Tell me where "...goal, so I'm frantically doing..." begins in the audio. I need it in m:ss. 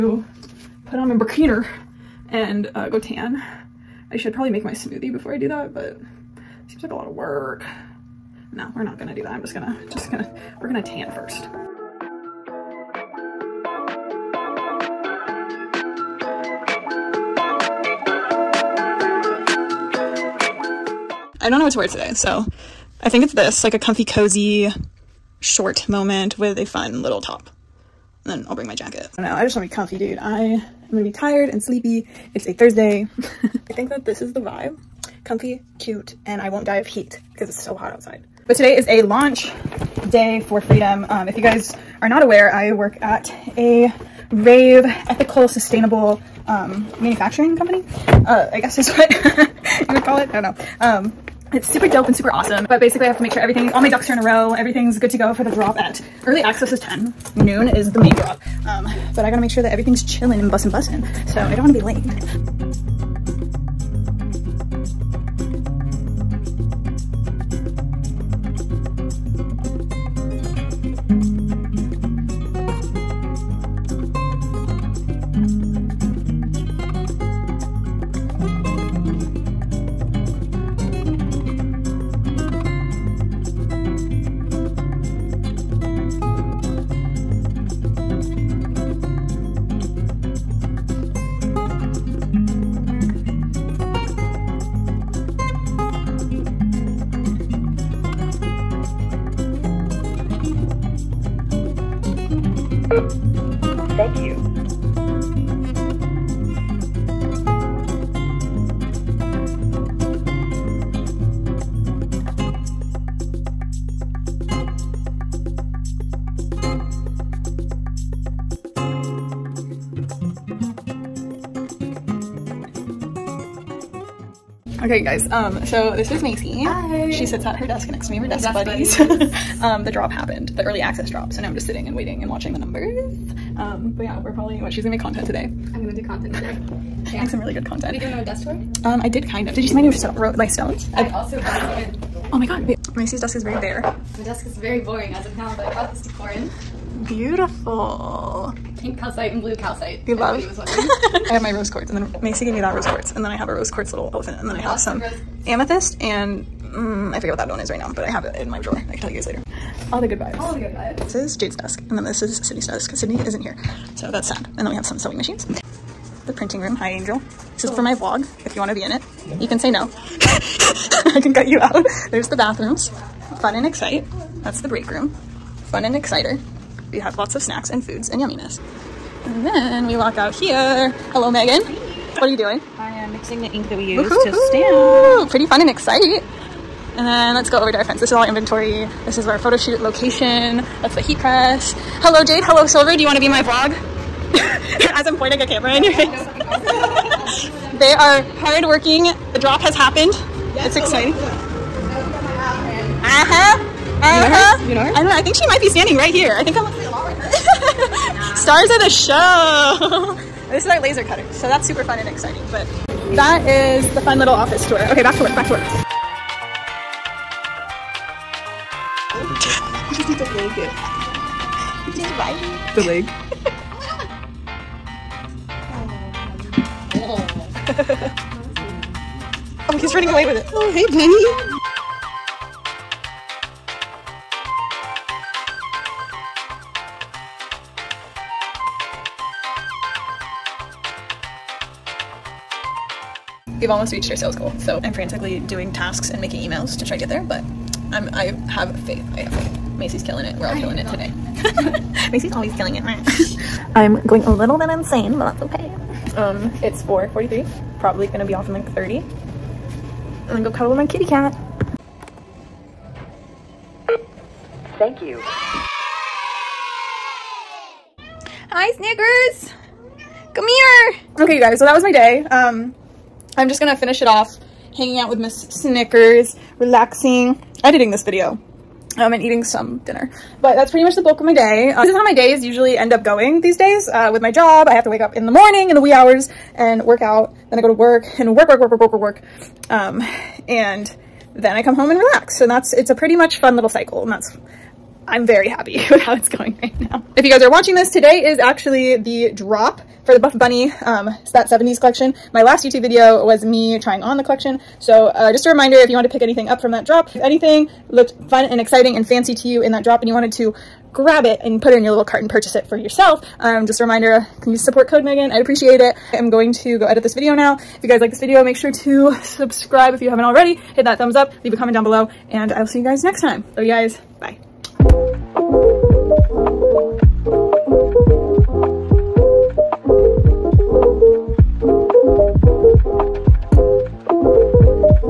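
4:04.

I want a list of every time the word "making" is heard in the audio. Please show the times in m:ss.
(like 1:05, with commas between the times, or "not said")
4:06.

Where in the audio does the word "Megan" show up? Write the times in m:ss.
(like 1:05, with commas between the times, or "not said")
3:01, 5:15.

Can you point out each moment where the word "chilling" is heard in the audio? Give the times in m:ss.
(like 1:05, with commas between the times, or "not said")
1:00.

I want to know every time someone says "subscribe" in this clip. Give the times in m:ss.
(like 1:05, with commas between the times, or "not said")
5:19.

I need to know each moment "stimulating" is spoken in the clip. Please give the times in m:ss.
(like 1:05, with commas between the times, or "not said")
not said.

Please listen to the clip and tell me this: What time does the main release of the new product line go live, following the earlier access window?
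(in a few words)
noon.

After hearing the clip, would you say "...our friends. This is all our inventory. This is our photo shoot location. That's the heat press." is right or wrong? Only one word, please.
right.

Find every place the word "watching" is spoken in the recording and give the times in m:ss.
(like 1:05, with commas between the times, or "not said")
2:12, 4:57.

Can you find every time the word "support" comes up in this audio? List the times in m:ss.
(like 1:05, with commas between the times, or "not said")
5:14.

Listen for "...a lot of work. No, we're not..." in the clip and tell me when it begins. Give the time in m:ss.
0:06.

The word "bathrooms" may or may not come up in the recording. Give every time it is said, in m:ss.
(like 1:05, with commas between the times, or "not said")
2:52.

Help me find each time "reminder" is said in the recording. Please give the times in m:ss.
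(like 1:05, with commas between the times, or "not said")
5:05, 5:13.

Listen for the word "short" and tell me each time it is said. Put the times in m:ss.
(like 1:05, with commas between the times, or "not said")
0:25.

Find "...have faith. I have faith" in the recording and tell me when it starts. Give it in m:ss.
4:08.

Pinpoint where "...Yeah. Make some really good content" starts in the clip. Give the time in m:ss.
2:17.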